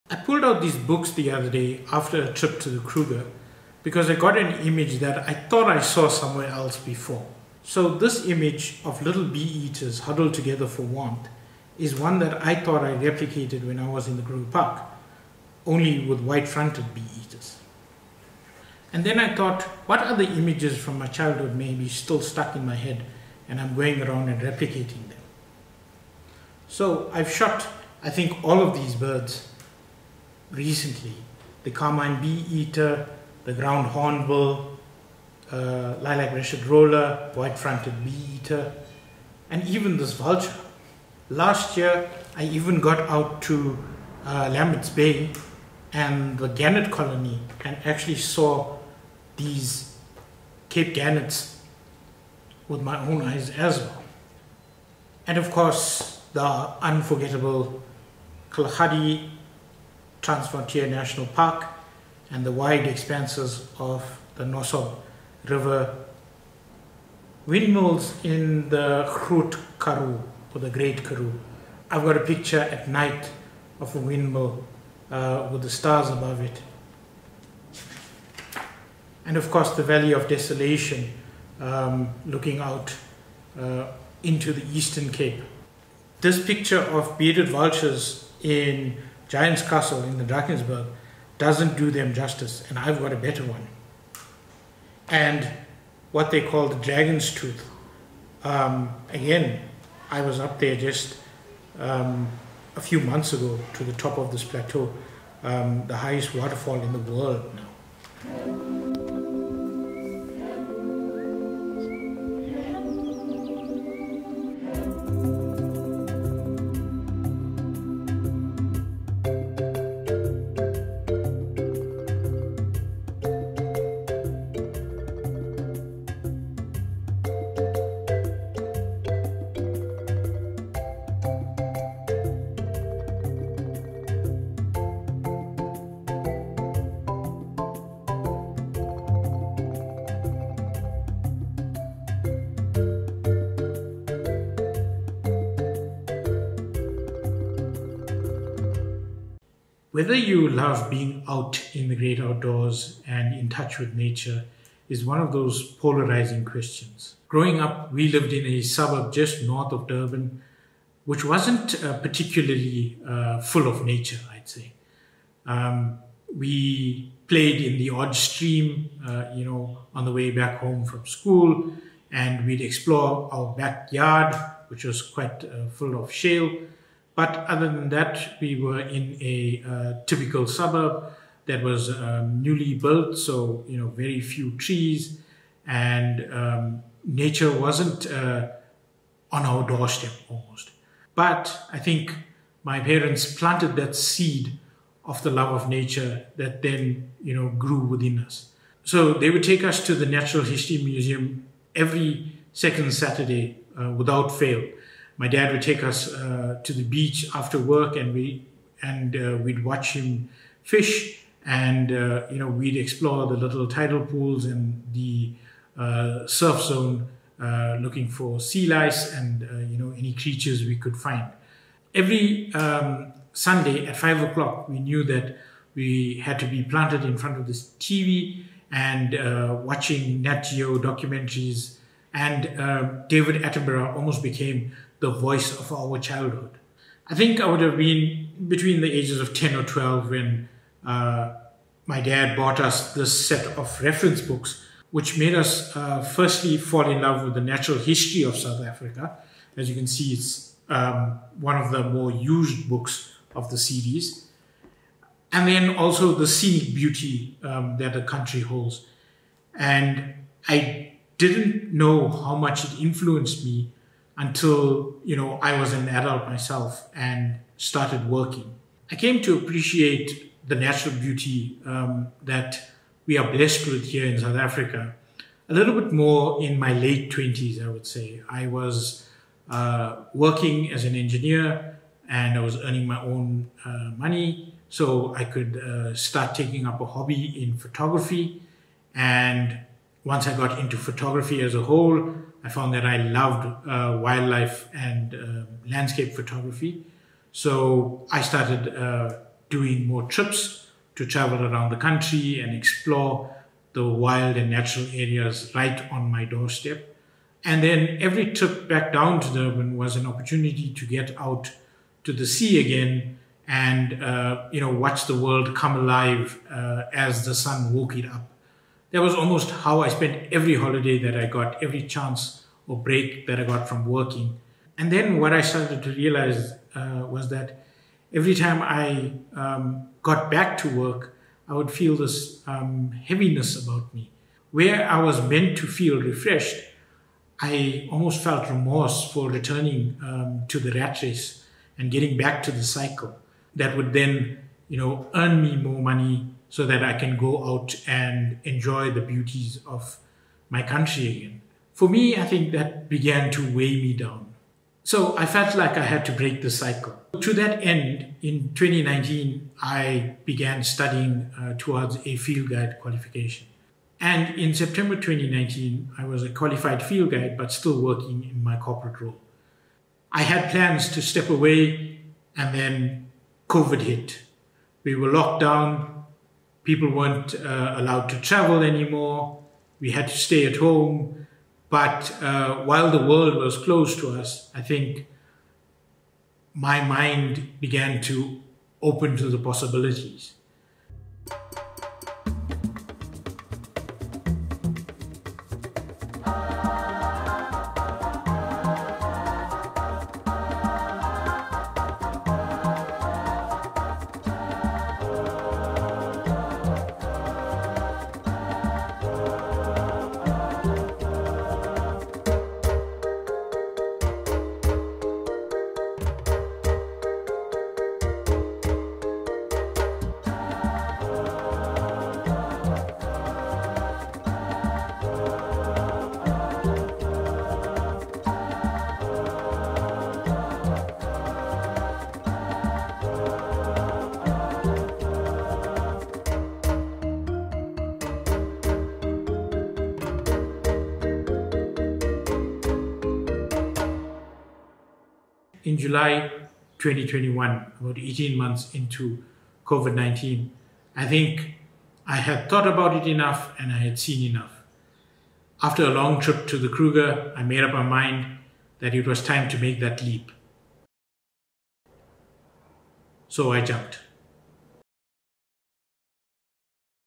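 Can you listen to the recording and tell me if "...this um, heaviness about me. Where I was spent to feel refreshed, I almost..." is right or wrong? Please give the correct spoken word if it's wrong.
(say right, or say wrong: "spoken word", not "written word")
wrong: "meant", not "spent".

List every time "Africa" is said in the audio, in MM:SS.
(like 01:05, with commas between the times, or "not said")
04:08, 04:34.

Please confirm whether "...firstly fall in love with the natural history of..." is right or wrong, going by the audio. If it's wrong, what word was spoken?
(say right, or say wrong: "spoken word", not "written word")
right.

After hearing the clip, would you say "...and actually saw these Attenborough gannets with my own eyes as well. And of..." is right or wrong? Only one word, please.
wrong.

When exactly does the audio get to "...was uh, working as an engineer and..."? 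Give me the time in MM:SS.
04:38.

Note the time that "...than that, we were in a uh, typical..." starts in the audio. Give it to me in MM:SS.
02:57.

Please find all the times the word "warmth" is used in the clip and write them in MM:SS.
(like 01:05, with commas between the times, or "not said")
00:10.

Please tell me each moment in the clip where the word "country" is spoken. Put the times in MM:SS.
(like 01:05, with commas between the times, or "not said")
04:18, 05:01, 05:50.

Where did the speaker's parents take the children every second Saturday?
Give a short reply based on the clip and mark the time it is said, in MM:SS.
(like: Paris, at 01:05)
Natural History Museum, at 03:20.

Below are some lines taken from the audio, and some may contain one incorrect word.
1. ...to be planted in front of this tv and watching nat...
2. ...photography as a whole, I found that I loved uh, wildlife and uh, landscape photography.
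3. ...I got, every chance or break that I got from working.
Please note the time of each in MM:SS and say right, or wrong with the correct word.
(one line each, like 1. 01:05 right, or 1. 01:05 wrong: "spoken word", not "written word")
1. 03:46 right
2. 04:50 right
3. 05:21 right.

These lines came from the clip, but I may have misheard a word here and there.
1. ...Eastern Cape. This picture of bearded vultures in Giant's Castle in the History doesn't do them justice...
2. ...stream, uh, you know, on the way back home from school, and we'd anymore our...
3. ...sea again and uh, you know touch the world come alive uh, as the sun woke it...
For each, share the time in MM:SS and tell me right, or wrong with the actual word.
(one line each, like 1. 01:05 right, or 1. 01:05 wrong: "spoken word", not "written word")
1. 01:24 wrong: "Drakensberg", not "History"
2. 02:48 wrong: "explore", not "anymore"
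3. 05:12 wrong: "watch", not "touch".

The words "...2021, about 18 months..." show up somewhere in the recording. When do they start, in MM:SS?
07:26.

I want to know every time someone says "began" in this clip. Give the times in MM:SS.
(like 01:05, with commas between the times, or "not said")
05:52, 06:00, 06:27.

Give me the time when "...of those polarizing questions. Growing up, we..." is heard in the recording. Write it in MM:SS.
02:35.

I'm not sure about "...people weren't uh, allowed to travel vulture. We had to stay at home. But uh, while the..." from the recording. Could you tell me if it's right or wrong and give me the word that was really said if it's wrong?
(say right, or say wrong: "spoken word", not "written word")
wrong: "anymore", not "vulture".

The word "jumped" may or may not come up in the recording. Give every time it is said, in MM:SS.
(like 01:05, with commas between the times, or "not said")
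07:43.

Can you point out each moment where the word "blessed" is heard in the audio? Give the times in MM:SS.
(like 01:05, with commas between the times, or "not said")
04:33.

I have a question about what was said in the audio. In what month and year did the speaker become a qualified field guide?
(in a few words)
September 2019.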